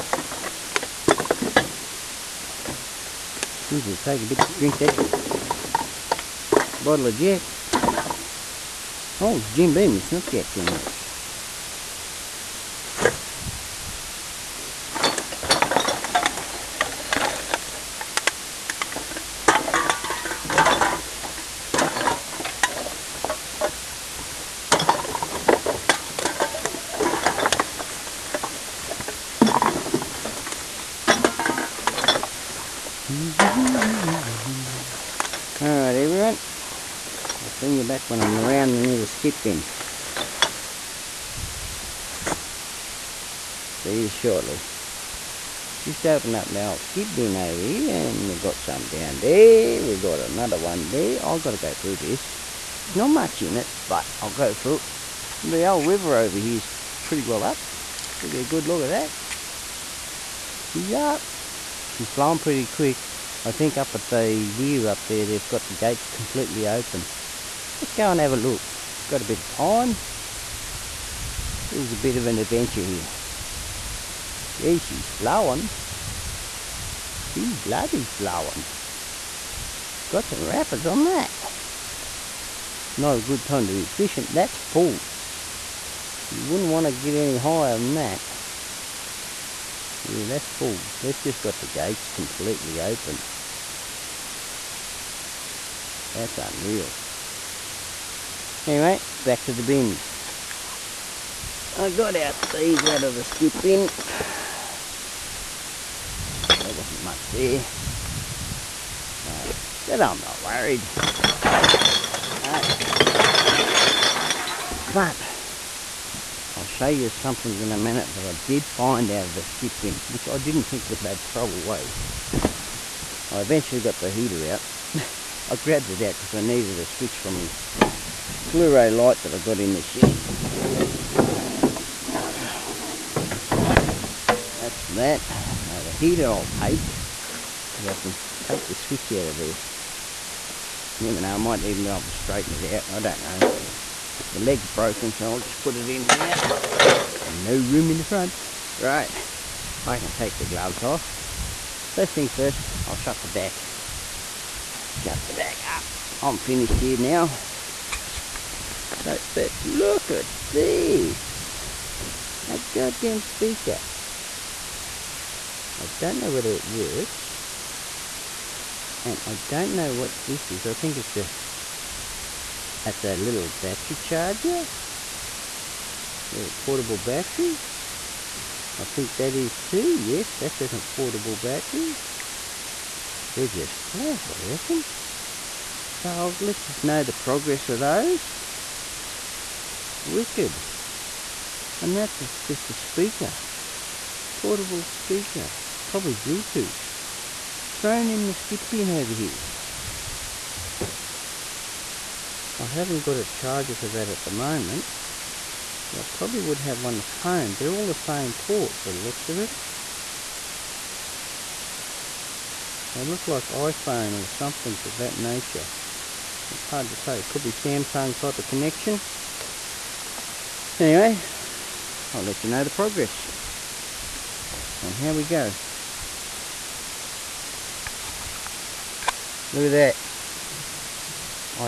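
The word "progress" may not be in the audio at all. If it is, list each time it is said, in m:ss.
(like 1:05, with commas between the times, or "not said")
3:07, 3:42.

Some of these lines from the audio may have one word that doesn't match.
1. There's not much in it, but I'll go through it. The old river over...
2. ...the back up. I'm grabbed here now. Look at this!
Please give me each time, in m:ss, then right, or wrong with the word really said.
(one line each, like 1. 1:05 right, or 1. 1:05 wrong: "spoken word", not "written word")
1. 0:52 right
2. 2:35 wrong: "finished", not "grabbed".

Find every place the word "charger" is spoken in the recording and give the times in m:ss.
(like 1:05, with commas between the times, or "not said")
2:53, 3:23.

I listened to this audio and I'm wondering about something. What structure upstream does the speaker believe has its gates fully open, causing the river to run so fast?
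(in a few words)
the weir.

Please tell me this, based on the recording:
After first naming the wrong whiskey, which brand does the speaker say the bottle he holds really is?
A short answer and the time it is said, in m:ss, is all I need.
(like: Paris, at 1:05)
Jim Beam, at 0:09.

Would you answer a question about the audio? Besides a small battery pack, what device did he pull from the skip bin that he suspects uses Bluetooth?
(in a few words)
portable speaker.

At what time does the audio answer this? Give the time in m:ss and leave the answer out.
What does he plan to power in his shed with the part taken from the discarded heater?
2:08.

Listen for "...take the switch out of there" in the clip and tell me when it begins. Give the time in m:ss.
2:18.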